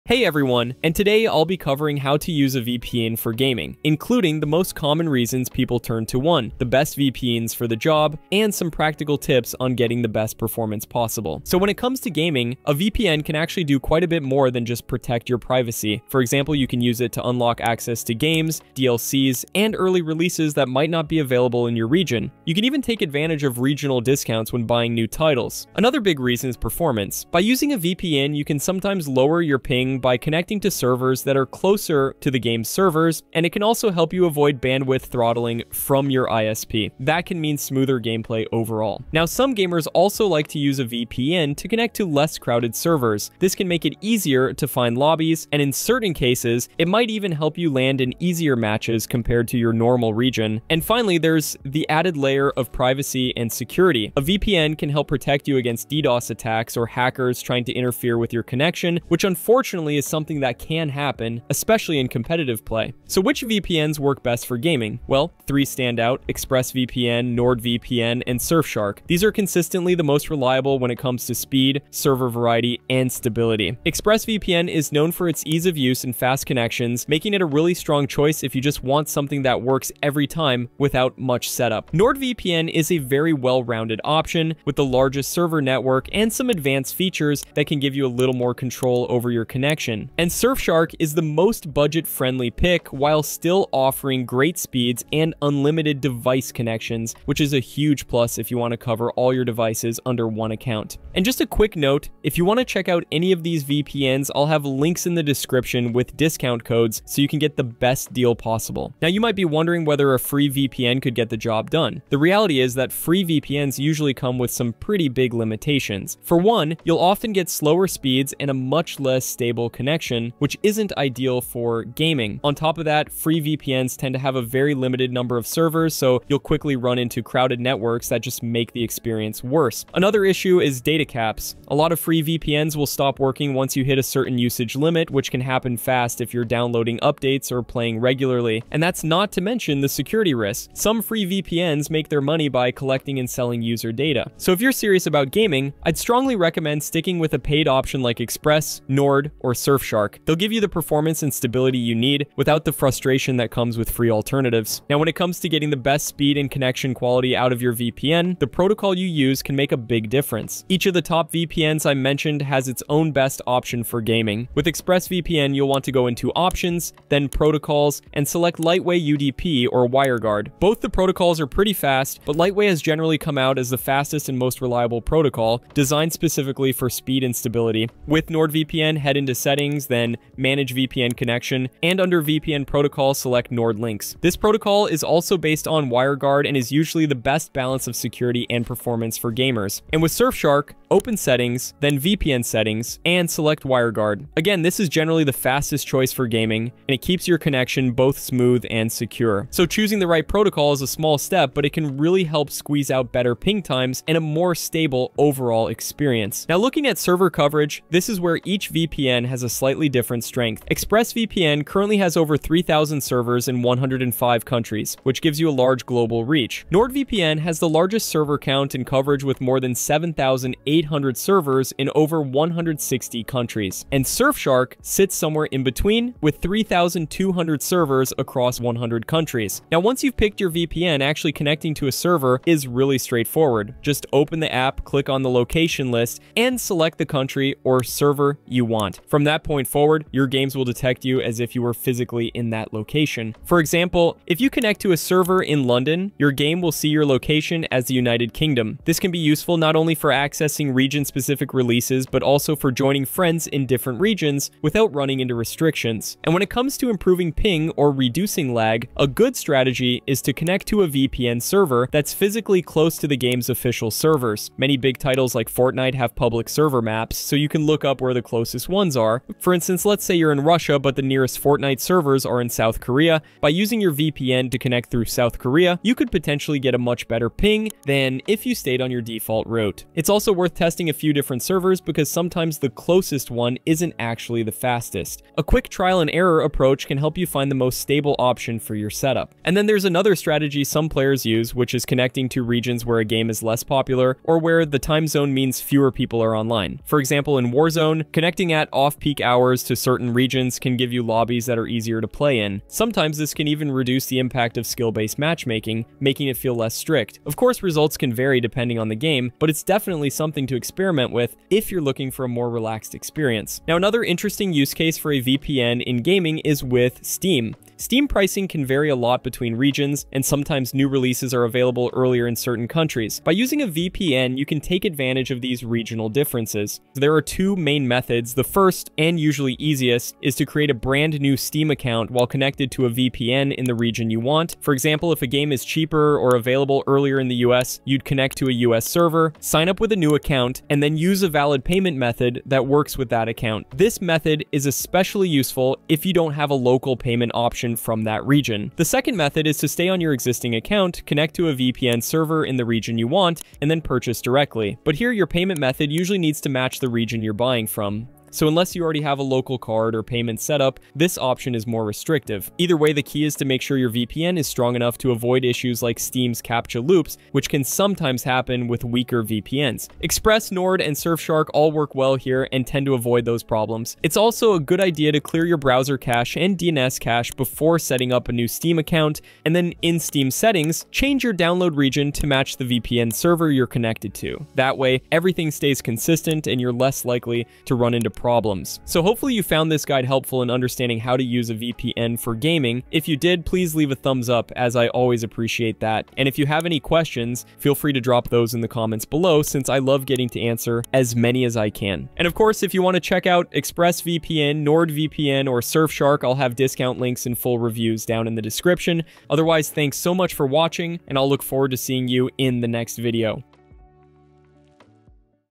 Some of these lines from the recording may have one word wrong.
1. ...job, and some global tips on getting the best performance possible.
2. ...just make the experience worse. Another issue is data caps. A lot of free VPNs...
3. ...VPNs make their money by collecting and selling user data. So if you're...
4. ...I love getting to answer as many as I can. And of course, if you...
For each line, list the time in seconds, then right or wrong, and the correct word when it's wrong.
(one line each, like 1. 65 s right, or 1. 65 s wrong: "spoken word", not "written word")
1. 7 s wrong: "practical", not "global"
2. 128 s right
3. 141 s right
4. 399 s right.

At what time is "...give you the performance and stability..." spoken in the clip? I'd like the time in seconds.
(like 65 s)
150 s.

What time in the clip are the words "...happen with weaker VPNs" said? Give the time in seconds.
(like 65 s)
368 s.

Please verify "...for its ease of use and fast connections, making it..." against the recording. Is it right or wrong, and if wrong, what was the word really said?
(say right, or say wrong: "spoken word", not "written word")
right.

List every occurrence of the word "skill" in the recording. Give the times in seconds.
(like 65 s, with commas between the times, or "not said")
304 s.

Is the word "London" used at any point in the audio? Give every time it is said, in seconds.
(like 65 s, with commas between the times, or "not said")
245 s.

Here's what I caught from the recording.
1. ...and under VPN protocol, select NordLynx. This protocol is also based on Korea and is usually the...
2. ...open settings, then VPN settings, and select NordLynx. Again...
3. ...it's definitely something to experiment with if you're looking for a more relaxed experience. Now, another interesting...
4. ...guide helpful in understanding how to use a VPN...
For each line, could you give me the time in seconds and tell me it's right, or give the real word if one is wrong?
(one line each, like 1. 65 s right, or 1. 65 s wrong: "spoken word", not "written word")
1. 181 s wrong: "WireGuard", not "Korea"
2. 190 s wrong: "WireGuard", not "NordLynx"
3. 309 s right
4. 389 s right.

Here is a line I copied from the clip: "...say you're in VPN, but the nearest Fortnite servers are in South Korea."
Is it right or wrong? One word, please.
wrong.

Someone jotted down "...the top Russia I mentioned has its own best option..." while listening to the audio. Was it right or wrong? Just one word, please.
wrong.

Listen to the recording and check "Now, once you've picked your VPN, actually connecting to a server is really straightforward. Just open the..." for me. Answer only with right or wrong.
right.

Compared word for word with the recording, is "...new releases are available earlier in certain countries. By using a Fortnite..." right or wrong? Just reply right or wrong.
wrong.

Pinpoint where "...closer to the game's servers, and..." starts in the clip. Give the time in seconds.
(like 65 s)
31 s.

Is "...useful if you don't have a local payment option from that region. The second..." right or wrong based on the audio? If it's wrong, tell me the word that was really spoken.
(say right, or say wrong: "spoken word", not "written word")
right.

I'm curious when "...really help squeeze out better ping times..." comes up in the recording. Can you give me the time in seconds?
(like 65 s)
201 s.